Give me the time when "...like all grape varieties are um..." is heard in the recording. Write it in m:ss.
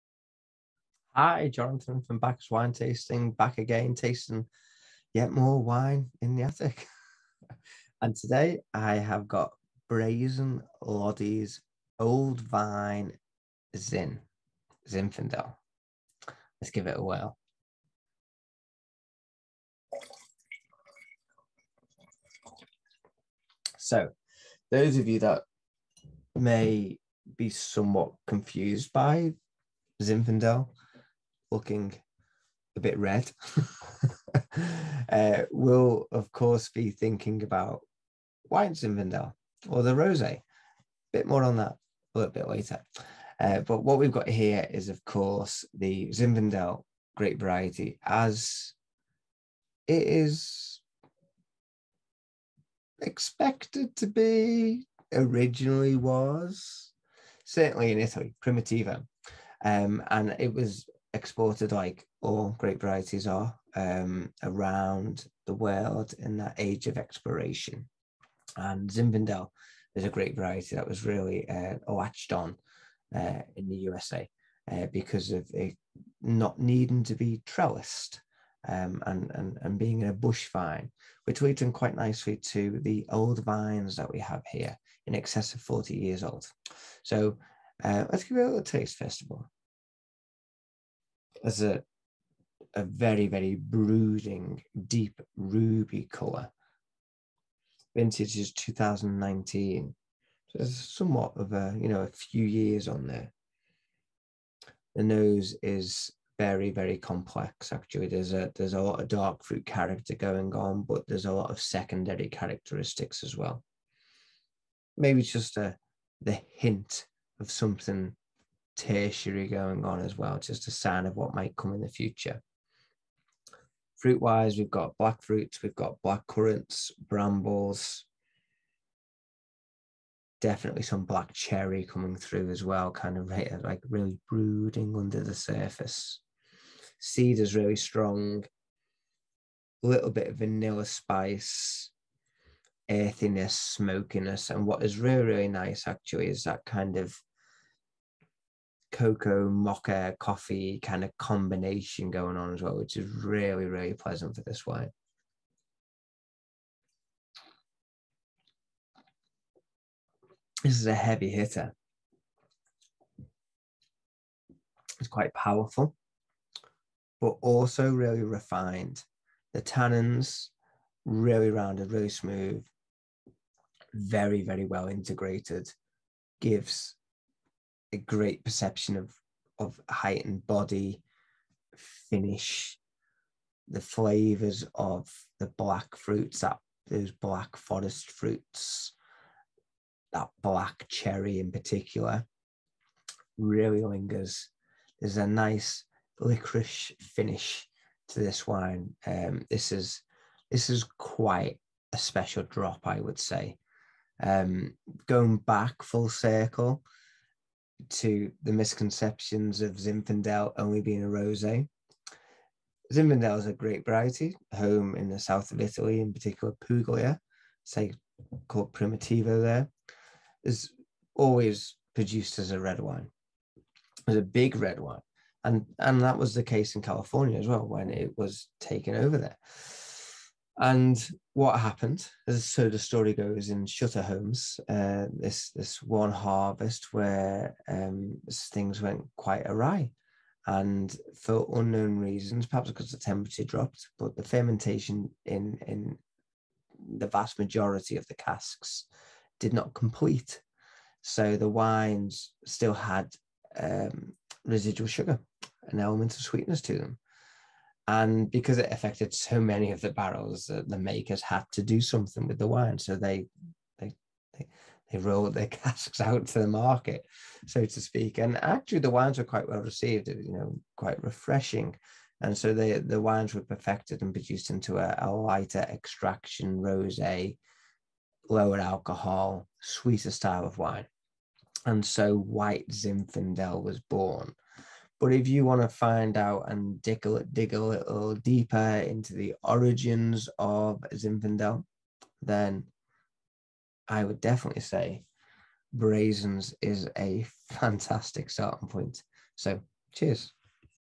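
1:01.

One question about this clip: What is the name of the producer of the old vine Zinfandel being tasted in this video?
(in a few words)
Brazin.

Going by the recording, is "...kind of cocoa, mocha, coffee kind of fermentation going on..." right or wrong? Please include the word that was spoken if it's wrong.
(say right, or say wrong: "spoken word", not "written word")
wrong: "combination", not "fermentation".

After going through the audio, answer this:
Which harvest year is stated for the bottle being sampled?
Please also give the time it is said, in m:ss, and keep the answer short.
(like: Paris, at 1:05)
2019, at 1:38.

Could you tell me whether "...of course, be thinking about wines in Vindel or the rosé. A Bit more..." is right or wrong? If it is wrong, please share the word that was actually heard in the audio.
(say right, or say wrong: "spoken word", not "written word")
right.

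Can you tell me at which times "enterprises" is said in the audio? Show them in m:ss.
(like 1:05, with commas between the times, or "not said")
not said.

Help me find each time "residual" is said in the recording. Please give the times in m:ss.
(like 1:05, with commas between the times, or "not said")
4:14.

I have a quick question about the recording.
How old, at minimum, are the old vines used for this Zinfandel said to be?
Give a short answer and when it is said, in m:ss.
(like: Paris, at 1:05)
40 years, at 1:25.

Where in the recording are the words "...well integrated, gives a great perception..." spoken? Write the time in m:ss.
2:54.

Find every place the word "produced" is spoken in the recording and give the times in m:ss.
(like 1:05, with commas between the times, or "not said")
3:41, 4:34.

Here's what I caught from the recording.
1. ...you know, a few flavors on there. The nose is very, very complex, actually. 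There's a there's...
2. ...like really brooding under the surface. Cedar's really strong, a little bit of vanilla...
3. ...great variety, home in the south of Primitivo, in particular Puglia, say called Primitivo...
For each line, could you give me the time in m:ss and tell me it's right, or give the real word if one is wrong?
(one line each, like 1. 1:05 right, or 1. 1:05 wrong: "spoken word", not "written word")
1. 1:41 wrong: "years", not "flavors"
2. 2:13 right
3. 3:33 wrong: "Italy", not "Primitivo".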